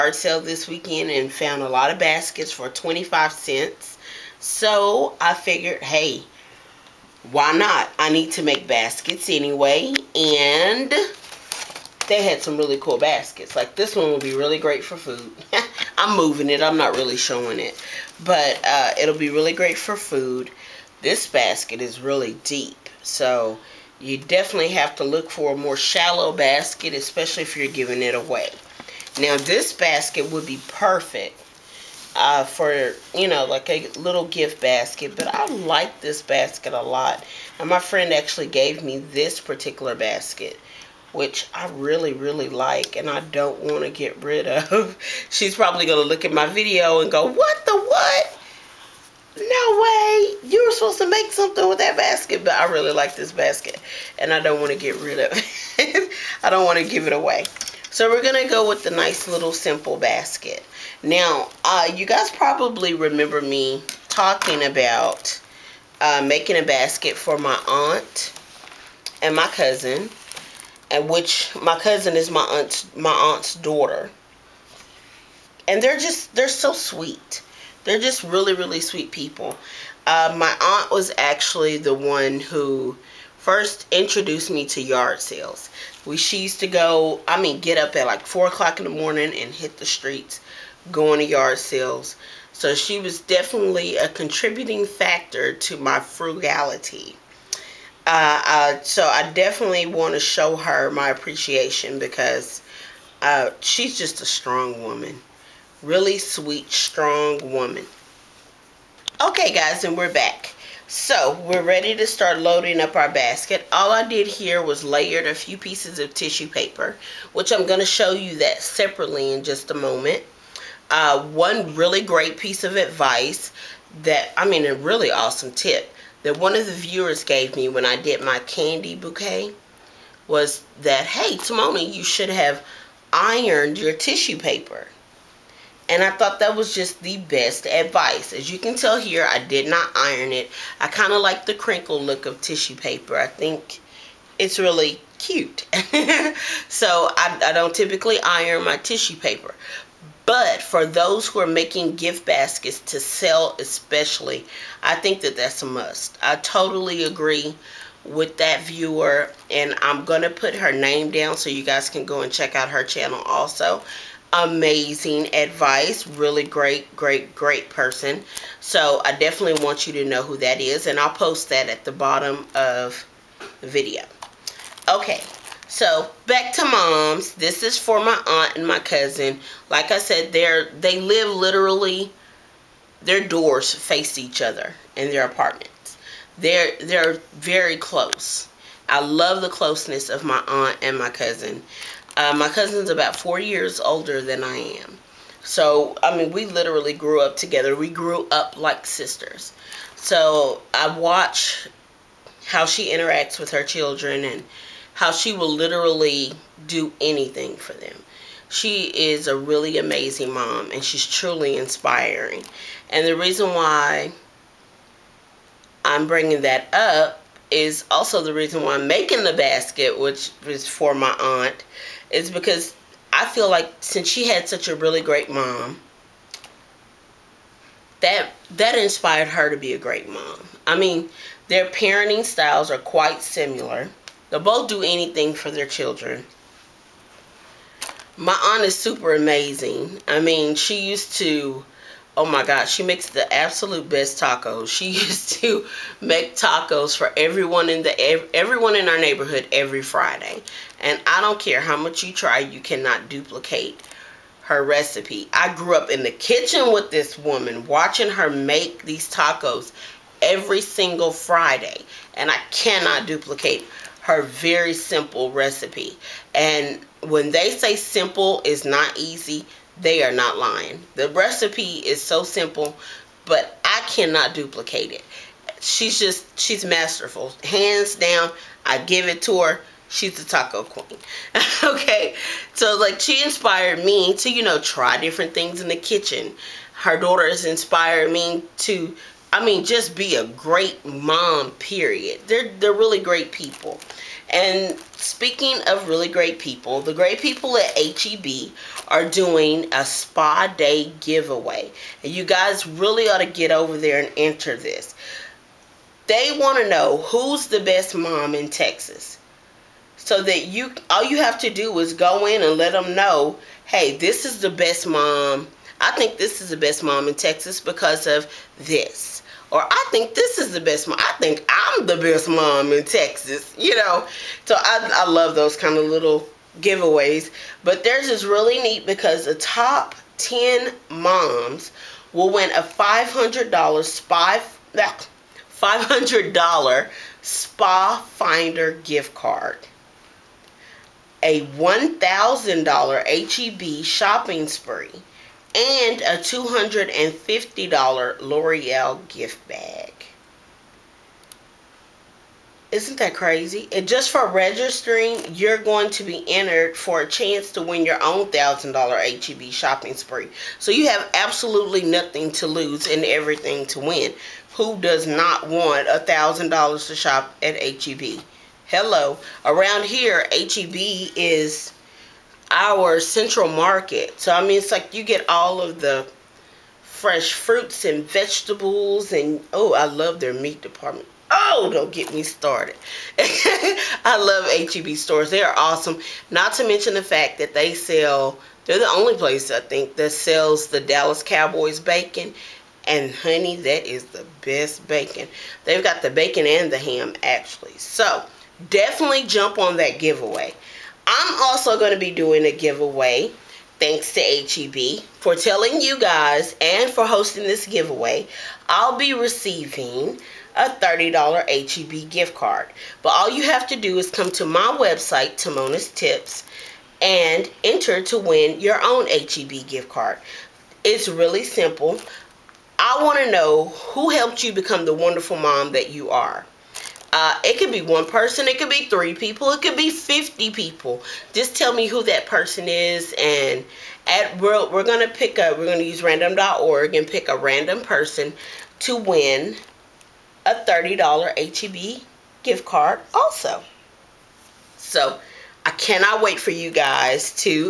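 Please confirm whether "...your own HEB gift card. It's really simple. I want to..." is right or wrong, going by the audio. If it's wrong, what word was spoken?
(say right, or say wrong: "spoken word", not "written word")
right.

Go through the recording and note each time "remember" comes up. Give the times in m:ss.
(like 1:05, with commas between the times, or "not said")
1:02.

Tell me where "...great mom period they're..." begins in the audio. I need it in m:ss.
4:50.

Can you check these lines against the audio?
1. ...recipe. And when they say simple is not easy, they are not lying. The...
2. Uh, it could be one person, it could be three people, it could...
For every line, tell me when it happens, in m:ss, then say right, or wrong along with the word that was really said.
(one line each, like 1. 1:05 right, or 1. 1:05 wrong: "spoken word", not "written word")
1. 4:25 right
2. 7:07 right.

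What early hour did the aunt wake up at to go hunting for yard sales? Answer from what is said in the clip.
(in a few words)
4 o'clock.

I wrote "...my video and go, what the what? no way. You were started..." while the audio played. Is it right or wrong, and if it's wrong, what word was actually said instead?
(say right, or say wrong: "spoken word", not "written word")
wrong: "supposed", not "started".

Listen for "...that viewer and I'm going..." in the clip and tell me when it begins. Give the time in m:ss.
2:38.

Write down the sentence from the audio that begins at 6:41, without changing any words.
I'm also going to be doing a giveaway thanks to HEB for telling you guys and for hosting this giveaway.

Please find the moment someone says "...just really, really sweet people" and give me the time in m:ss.
1:17.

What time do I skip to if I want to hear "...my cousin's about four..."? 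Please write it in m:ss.
3:12.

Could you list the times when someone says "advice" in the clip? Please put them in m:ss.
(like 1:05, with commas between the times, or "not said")
2:02, 2:17, 2:45.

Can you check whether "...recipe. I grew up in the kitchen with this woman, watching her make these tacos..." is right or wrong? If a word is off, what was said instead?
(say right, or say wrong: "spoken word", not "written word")
right.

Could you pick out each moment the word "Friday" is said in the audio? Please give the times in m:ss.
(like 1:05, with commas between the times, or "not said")
4:09, 4:21.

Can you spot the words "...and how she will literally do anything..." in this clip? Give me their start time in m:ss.
3:24.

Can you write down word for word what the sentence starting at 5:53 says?
And just for registering, you're going to be entered for a chance to win your own $1,000 HEB shopping spree.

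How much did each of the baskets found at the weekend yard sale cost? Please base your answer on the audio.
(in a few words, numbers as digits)
25 cents.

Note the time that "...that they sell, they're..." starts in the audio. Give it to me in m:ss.
6:27.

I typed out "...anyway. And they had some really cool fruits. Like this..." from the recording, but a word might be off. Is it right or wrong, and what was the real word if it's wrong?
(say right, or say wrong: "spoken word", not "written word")
wrong: "baskets", not "fruits".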